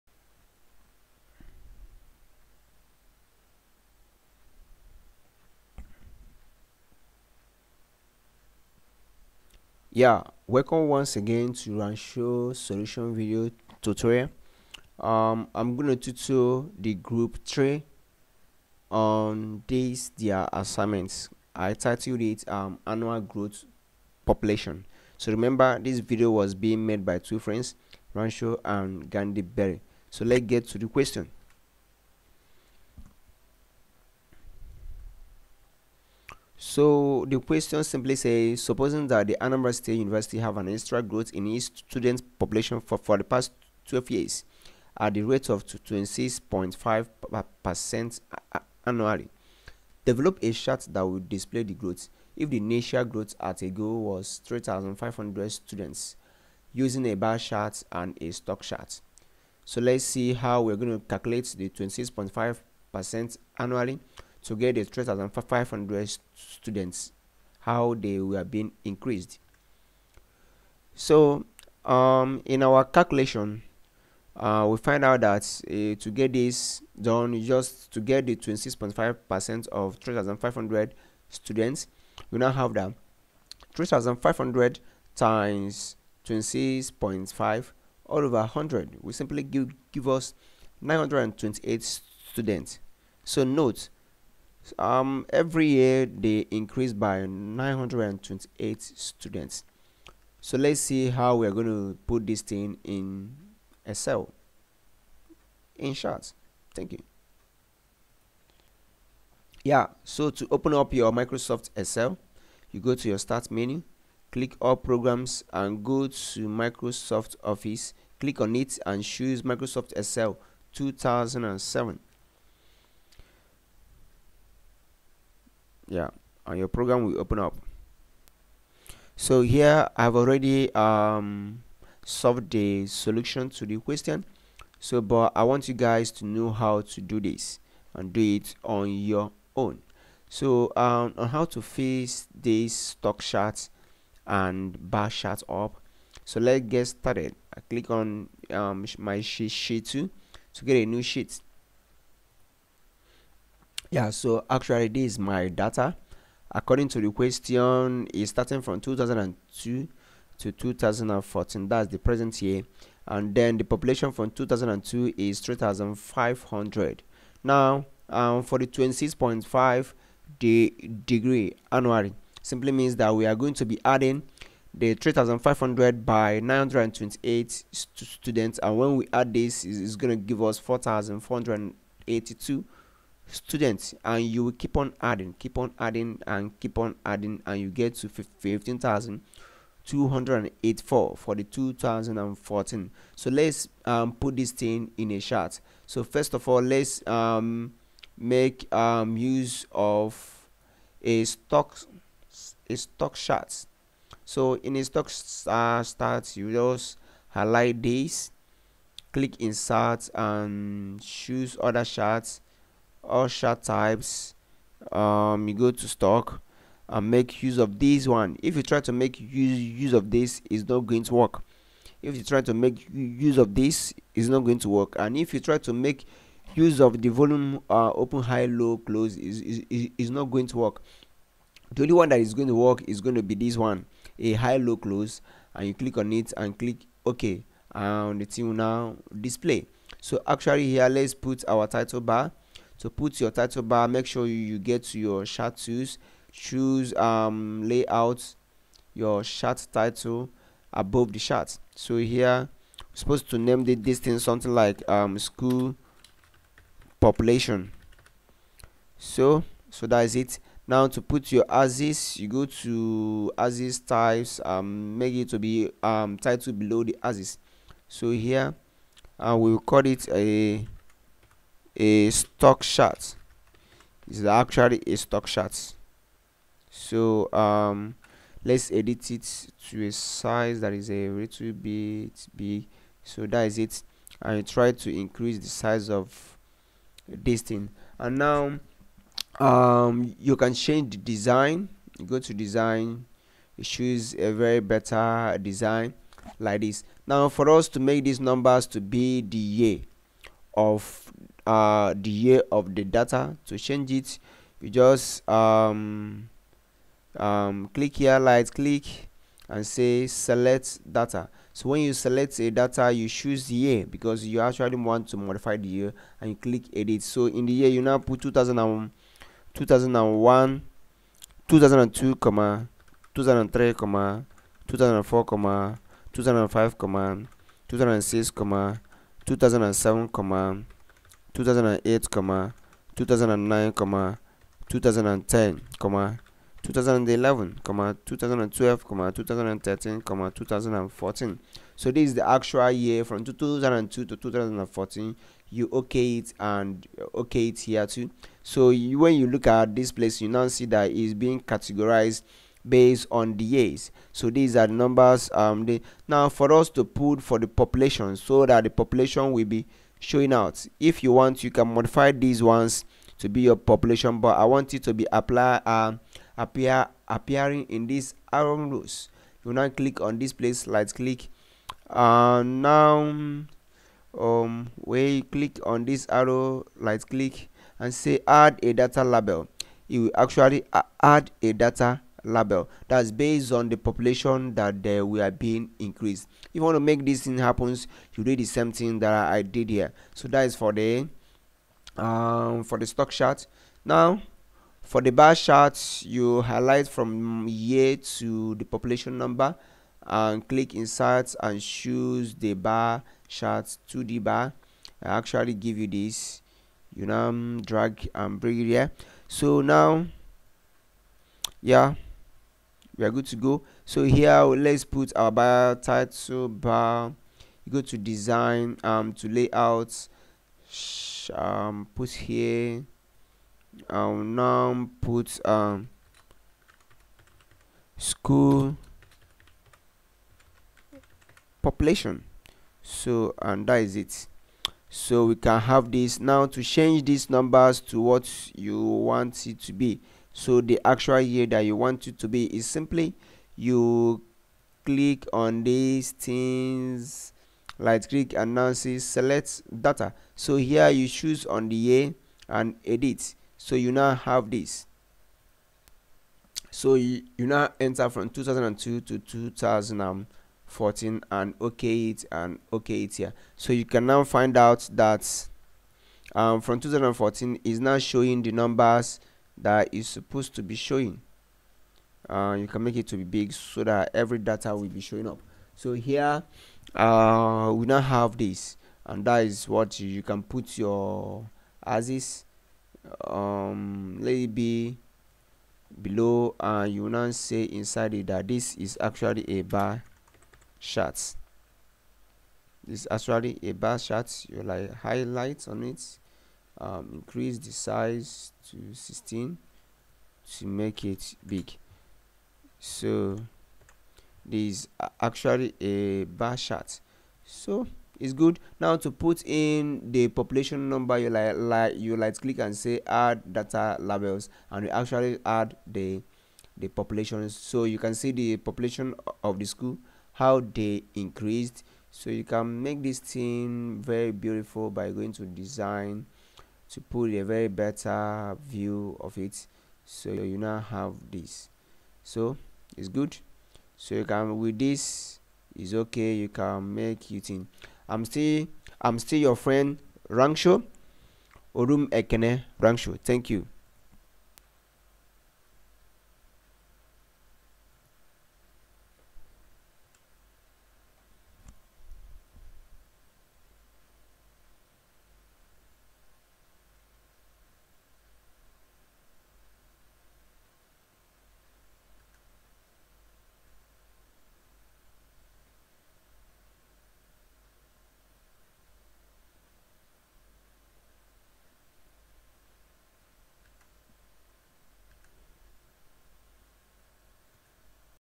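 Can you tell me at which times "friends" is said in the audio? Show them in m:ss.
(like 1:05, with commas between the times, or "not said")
0:27, 8:59.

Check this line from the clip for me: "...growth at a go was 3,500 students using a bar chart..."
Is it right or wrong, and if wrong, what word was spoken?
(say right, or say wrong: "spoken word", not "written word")
right.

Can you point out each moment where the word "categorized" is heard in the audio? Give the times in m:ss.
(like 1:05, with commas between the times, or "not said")
5:51.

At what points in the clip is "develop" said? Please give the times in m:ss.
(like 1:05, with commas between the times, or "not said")
0:50.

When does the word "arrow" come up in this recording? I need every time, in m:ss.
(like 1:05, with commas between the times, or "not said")
6:08, 6:16.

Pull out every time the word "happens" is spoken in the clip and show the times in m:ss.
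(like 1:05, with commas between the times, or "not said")
6:27.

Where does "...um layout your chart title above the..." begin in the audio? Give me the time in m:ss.
4:06.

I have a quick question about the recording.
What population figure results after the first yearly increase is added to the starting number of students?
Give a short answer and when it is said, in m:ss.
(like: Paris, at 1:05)
4482, at 3:00.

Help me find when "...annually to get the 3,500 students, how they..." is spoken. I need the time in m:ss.
1:03.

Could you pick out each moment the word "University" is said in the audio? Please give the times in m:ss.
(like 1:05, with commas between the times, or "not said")
0:39.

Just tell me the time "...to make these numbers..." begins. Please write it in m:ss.
4:57.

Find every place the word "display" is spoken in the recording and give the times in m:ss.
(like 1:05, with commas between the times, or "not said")
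0:51, 3:59.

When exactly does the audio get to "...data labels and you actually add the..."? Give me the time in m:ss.
8:33.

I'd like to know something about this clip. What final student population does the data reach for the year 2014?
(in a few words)
15,284.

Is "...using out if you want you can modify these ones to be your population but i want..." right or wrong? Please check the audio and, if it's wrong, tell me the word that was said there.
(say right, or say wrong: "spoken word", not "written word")
wrong: "showing", not "using".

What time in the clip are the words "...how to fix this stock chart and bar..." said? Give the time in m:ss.
2:21.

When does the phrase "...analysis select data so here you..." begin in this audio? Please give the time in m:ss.
7:28.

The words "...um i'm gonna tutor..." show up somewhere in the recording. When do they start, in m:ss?
0:15.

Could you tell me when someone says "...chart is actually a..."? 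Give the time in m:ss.
4:32.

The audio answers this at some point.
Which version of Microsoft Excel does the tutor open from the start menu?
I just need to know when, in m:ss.
1:59.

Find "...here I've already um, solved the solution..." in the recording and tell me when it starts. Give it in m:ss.
2:09.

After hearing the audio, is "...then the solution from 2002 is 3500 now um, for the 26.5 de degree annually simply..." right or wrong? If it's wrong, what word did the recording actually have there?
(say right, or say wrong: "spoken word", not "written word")
wrong: "population", not "solution".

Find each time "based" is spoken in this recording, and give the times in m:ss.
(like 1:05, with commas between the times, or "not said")
5:52, 6:23.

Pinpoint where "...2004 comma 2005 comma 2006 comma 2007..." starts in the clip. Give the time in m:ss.
5:24.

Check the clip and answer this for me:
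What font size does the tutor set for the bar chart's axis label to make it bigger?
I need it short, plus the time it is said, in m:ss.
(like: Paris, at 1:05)
16, at 8:18.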